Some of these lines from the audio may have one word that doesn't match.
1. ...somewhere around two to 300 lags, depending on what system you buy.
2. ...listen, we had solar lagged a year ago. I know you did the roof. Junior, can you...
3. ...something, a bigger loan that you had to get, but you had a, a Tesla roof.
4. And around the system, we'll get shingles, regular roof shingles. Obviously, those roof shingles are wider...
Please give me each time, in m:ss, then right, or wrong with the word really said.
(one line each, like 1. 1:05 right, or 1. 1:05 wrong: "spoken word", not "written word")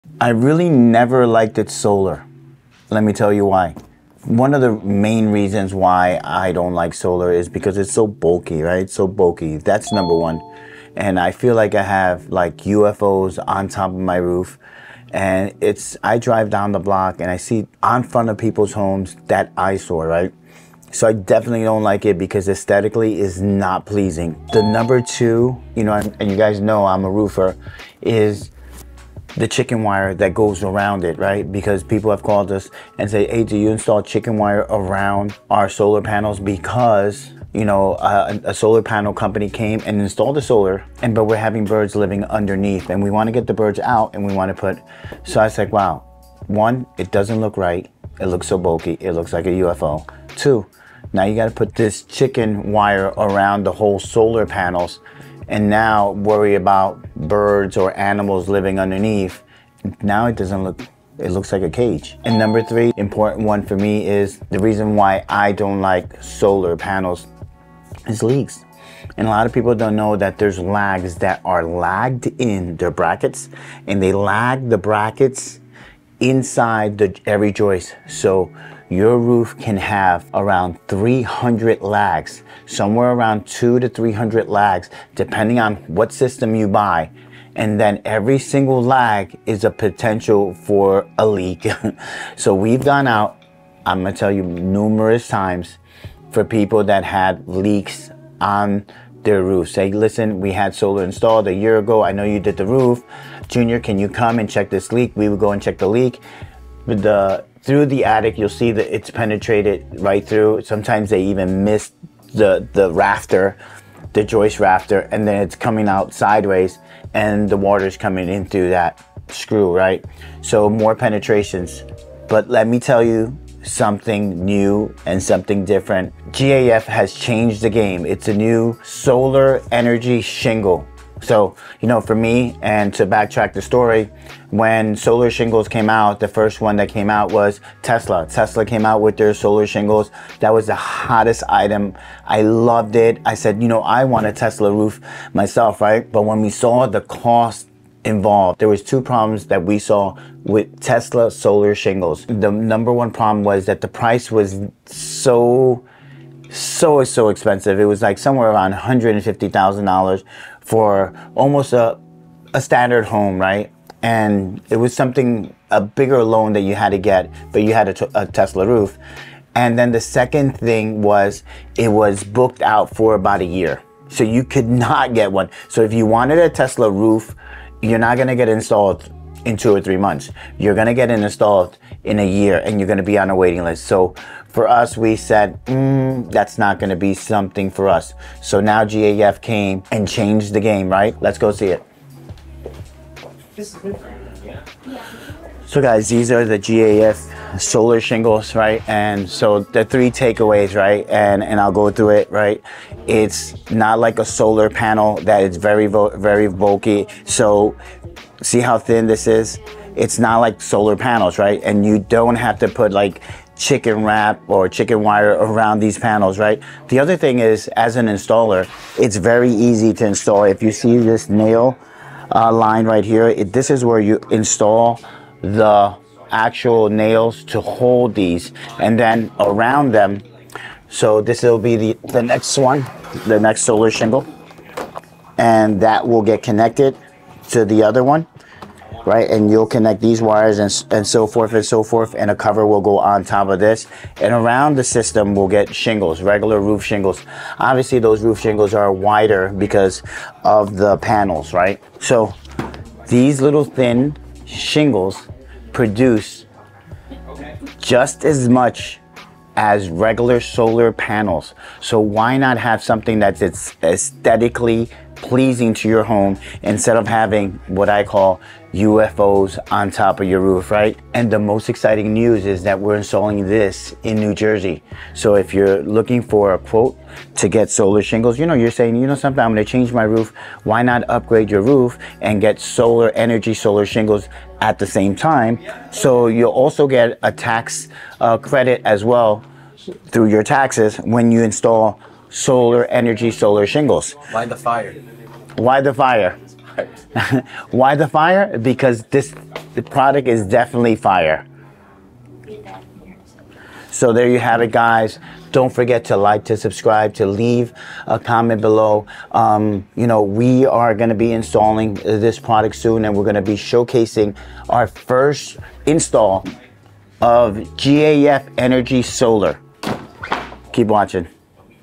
1. 1:22 right
2. 1:39 wrong: "installed", not "lagged"
3. 2:44 right
4. 4:04 right.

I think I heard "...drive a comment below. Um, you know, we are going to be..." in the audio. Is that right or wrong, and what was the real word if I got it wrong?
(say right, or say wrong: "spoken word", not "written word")
wrong: "leave", not "drive".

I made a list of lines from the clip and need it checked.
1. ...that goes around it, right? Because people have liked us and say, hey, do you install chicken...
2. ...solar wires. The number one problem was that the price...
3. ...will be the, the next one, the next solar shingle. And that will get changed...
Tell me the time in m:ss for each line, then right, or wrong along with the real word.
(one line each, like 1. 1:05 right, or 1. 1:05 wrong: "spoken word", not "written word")
1. 0:30 wrong: "called", not "liked"
2. 2:31 wrong: "shingles", not "wires"
3. 3:51 wrong: "connected", not "changed".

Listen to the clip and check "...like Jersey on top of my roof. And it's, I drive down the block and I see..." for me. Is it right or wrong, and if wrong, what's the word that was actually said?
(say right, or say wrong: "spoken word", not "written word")
wrong: "UFOs", not "Jersey".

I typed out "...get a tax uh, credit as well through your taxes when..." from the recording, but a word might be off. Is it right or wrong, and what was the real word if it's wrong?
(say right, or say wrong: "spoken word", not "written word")
right.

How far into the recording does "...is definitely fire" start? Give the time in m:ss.
5:00.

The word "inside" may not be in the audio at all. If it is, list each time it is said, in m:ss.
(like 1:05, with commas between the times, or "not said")
1:16.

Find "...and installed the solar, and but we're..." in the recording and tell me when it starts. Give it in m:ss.
0:39.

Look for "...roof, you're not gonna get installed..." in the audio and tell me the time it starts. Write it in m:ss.
2:56.